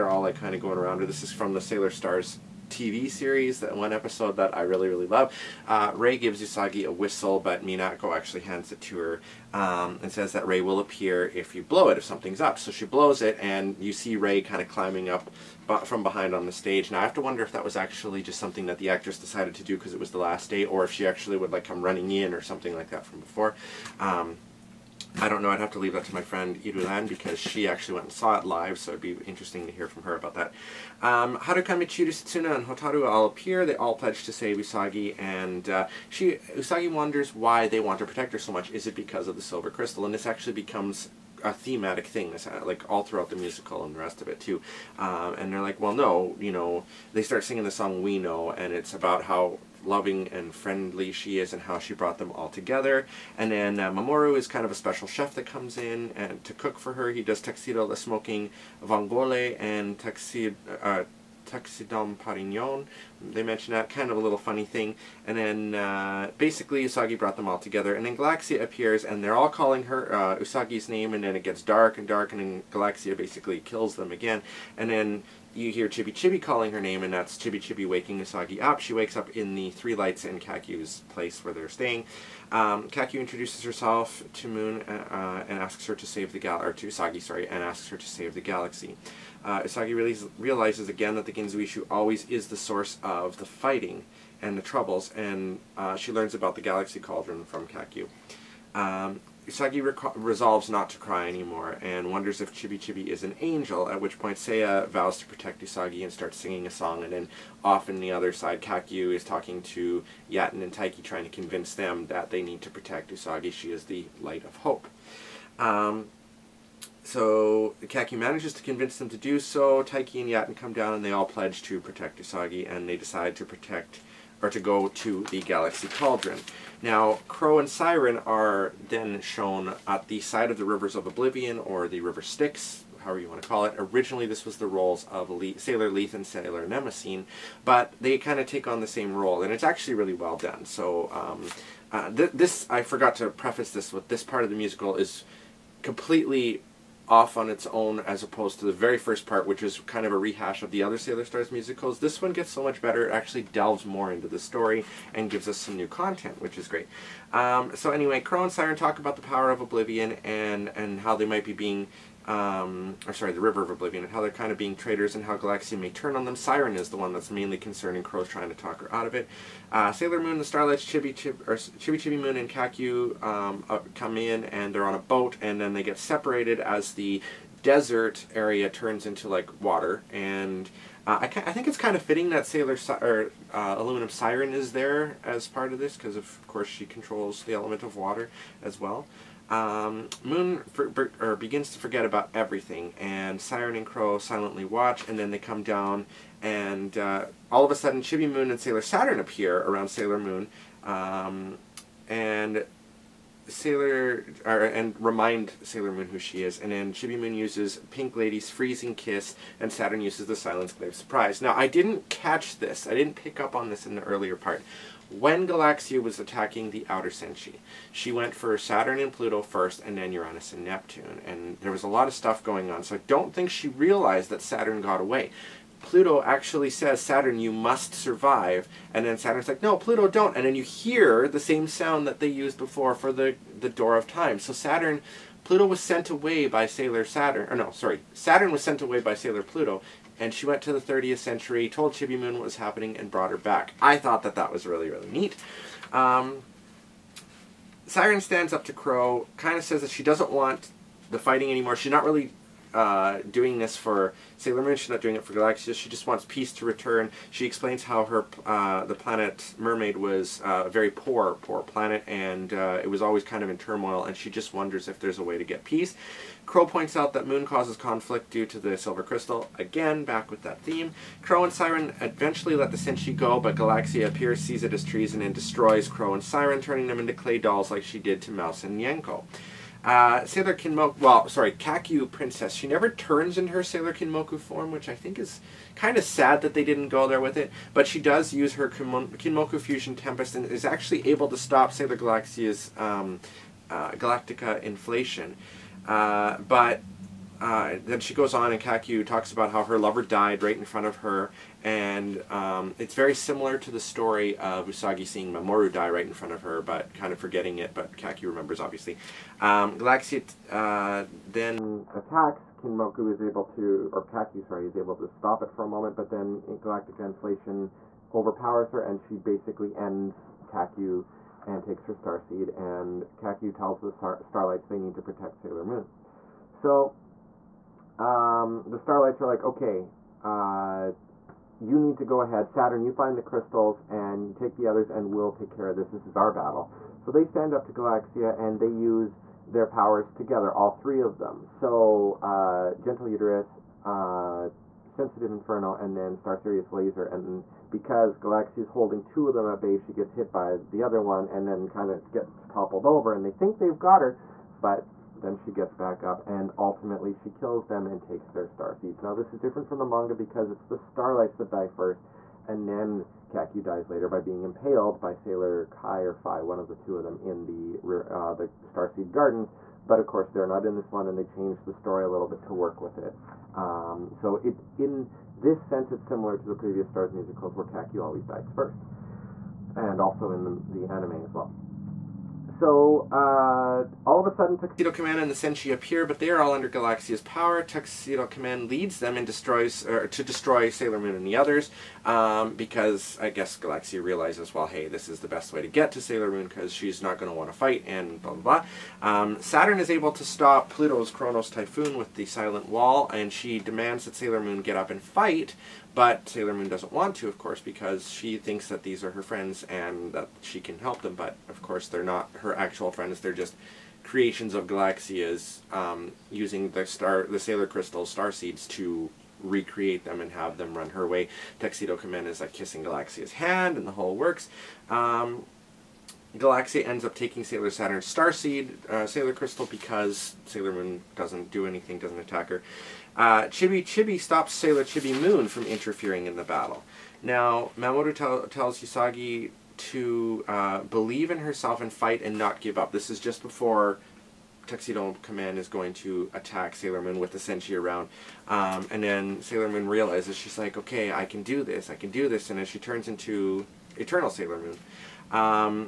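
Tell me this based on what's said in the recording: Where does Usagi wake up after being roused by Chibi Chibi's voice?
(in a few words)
Kakyu's place.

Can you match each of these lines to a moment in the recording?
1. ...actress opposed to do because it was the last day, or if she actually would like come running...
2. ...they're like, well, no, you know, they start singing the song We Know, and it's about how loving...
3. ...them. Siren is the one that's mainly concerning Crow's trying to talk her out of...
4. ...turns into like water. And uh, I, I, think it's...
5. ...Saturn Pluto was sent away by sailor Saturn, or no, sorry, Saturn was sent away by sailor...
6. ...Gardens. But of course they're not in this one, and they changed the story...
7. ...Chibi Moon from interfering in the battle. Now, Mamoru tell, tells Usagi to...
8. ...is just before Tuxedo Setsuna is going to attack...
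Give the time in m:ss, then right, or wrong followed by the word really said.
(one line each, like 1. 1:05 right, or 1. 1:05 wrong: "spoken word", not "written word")
1. 0:18 wrong: "decided", not "opposed"
2. 0:45 right
3. 2:46 right
4. 2:58 right
5. 3:54 right
6. 6:09 right
7. 7:14 right
8. 7:23 wrong: "Kamen", not "Setsuna".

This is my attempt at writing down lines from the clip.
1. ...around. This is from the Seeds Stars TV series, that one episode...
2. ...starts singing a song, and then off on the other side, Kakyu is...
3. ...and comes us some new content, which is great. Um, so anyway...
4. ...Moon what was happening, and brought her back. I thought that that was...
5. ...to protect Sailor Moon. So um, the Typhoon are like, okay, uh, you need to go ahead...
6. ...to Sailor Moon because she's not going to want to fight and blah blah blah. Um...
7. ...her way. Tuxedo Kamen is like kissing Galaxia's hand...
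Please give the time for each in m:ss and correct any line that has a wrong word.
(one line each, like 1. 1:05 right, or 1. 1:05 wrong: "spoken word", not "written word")
1. 0:00 wrong: "Sailor", not "Seeds"
2. 1:46 right
3. 2:35 wrong: "gives", not "comes"
4. 4:02 right
5. 5:24 wrong: "Starlights", not "Typhoon"
6. 6:35 right
7. 7:00 right.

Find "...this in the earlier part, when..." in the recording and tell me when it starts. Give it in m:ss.
3:33.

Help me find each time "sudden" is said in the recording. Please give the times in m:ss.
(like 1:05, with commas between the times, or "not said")
3:17, 6:24.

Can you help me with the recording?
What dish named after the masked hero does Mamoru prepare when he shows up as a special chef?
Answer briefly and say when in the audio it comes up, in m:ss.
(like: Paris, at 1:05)
tuxedo the smoking vongole, at 0:57.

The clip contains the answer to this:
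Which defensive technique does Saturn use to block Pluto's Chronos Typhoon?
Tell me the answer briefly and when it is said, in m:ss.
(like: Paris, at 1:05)
Silent Wall, at 6:42.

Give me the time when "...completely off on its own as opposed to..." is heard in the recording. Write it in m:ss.
2:25.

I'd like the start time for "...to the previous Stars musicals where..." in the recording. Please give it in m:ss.
6:16.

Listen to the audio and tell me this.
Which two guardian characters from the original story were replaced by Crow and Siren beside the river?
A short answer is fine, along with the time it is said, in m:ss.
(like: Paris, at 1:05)
Sailor Lethe and Sailor Mnemosyne, at 2:15.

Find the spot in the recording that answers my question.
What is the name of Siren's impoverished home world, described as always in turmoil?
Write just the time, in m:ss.
4:19.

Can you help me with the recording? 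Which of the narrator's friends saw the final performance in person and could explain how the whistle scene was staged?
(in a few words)
Irulan.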